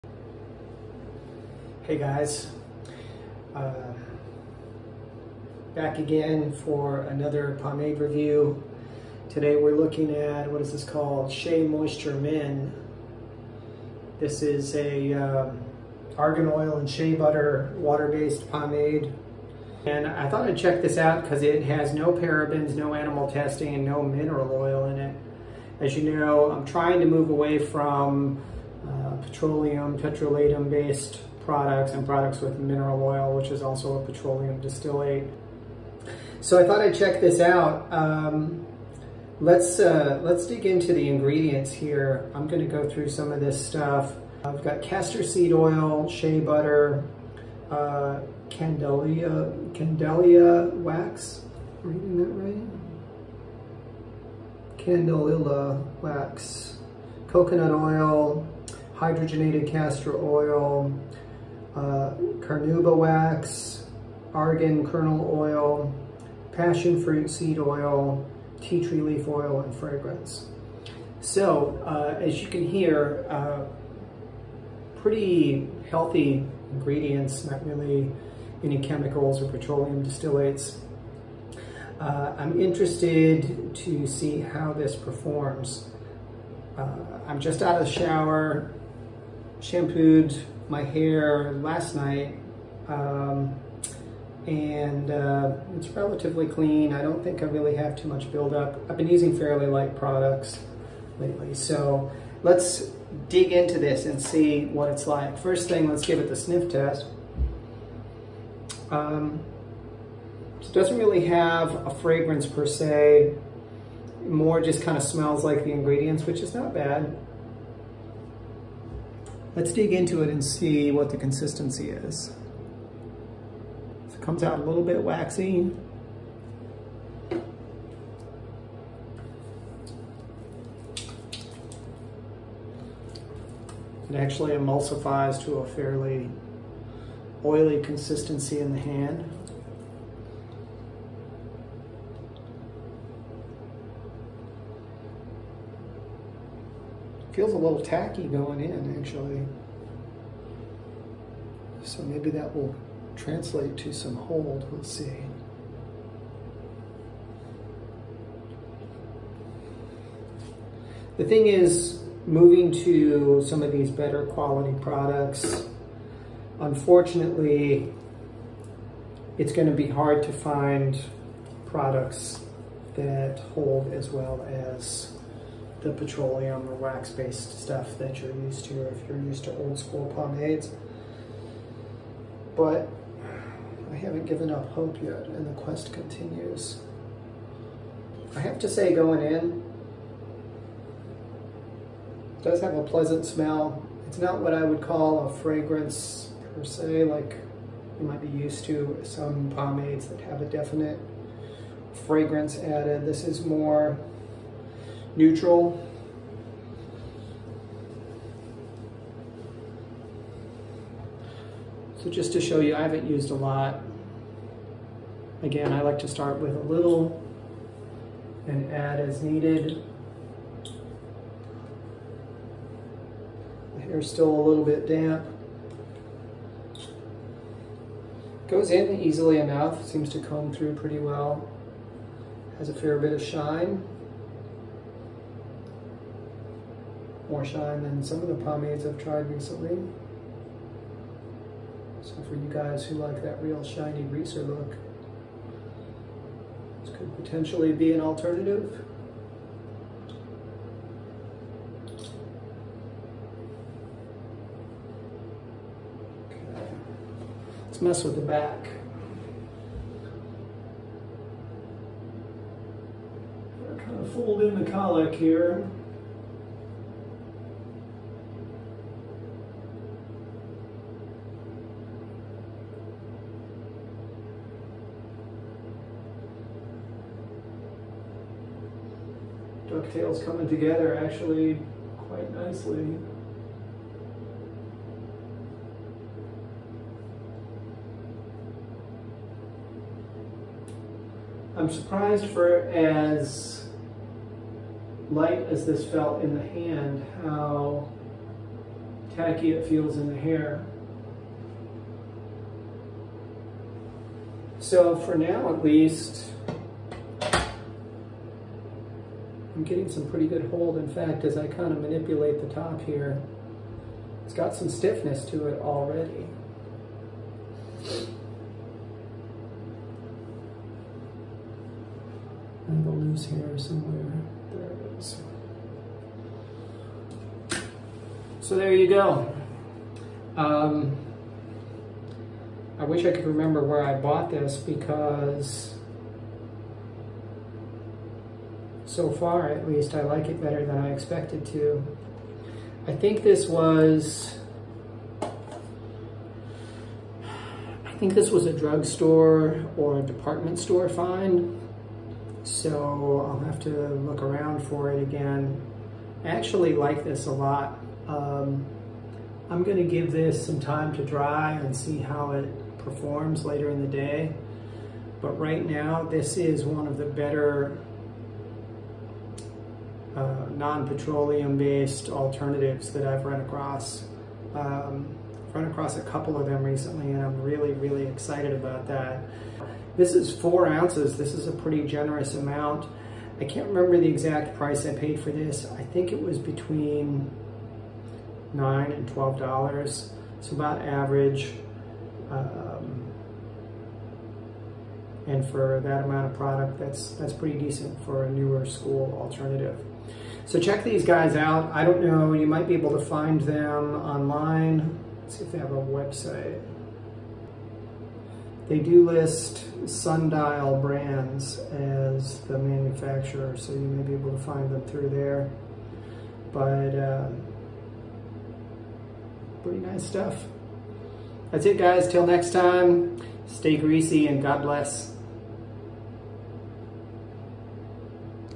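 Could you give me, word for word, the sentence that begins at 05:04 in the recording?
So for now at least, I'm getting some pretty good hold.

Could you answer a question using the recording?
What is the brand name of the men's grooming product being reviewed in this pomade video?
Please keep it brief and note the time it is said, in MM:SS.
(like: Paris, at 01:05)
Shea Moisture Men, at 00:11.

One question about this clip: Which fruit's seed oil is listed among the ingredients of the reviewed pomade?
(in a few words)
passion fruit.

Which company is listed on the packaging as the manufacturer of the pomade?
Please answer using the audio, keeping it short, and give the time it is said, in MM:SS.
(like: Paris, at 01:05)
Sundial Brands, at 06:49.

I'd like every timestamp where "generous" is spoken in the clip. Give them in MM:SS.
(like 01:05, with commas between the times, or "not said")
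06:21.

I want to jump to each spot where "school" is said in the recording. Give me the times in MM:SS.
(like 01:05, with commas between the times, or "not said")
02:59, 06:38.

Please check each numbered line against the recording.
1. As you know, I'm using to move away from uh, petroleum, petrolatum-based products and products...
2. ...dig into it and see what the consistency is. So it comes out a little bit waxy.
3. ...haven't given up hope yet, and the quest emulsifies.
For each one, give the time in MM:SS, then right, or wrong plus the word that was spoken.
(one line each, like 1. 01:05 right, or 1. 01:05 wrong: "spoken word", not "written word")
1. 00:25 wrong: "trying", not "using"
2. 01:59 right
3. 03:03 wrong: "continues", not "emulsifies".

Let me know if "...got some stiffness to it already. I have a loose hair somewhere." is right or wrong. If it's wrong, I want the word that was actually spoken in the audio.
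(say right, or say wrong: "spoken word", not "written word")
right.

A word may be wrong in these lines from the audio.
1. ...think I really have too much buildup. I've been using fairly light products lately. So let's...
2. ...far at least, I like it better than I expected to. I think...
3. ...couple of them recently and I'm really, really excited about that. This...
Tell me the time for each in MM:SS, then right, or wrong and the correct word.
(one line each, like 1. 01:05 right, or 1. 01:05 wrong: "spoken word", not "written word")
1. 01:37 right
2. 05:39 right
3. 06:16 right.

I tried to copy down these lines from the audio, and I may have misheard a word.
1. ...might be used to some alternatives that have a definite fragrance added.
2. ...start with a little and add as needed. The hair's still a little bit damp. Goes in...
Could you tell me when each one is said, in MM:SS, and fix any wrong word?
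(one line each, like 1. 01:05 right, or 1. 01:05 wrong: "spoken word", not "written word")
1. 03:18 wrong: "pomades", not "alternatives"
2. 03:36 right.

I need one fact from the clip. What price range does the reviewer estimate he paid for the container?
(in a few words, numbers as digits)
$9 to $12.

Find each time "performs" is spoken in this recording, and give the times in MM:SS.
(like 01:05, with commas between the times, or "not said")
01:24, 06:02.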